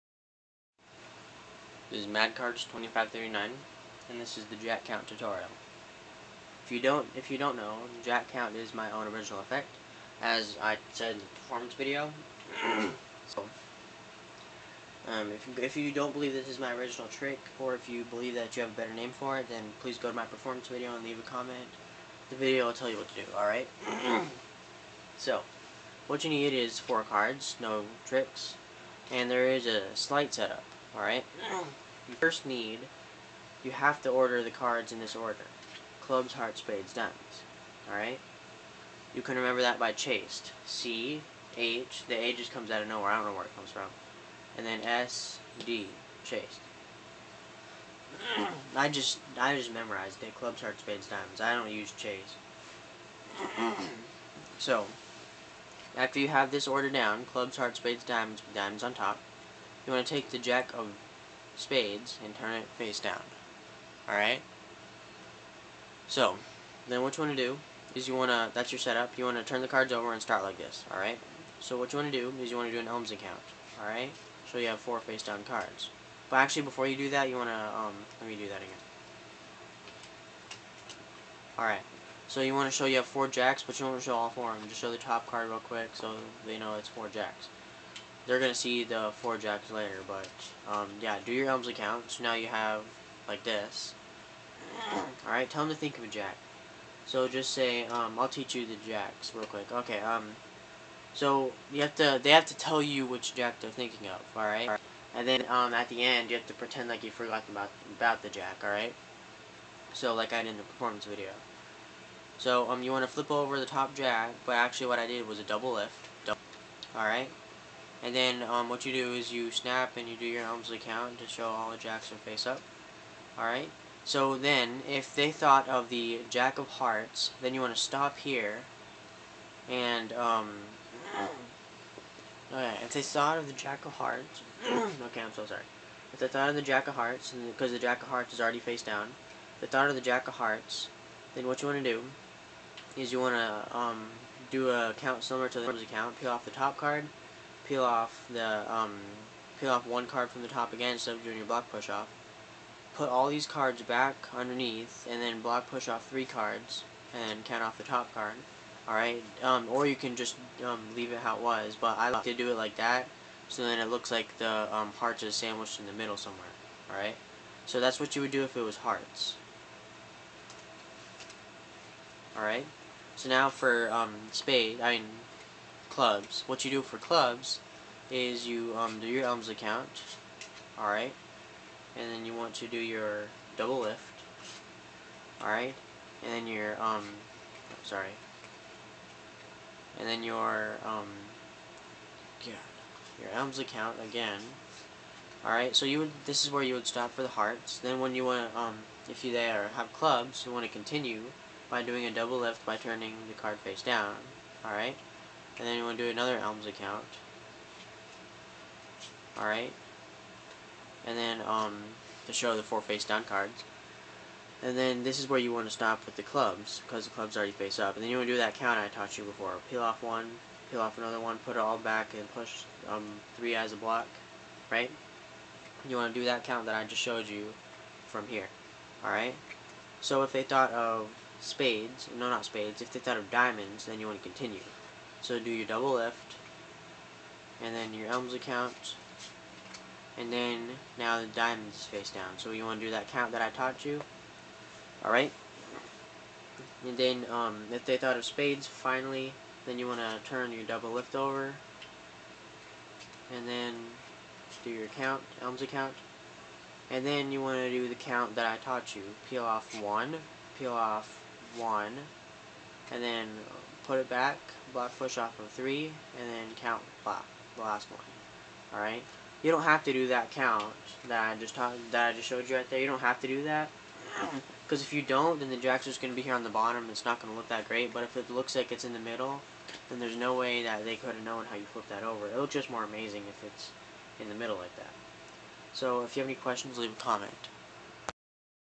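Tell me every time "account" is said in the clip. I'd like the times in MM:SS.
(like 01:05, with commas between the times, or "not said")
02:25, 04:15.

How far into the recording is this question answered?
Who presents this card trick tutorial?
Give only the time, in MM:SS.
00:02.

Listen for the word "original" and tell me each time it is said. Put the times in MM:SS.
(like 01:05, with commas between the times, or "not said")
00:09, 00:16.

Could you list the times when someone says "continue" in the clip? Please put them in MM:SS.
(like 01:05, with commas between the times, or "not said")
03:20, 03:54.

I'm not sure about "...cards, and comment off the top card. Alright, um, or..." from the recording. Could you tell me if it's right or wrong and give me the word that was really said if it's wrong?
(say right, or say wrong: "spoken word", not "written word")
wrong: "count", not "comment".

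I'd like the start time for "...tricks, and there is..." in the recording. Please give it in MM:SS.
00:28.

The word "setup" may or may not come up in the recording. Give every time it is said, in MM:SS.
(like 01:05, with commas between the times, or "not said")
00:30, 01:08.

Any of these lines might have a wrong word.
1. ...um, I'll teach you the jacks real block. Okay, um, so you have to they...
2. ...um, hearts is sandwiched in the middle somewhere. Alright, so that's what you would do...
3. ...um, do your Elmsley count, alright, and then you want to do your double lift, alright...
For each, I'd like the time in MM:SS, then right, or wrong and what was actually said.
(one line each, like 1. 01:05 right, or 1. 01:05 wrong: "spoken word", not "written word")
1. 01:37 wrong: "quick", not "block"
2. 02:44 right
3. 02:58 right.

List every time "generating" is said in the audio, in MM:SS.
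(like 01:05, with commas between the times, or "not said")
not said.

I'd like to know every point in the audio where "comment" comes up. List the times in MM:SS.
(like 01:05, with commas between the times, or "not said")
00:21, 04:46.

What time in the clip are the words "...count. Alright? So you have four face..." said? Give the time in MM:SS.
01:13.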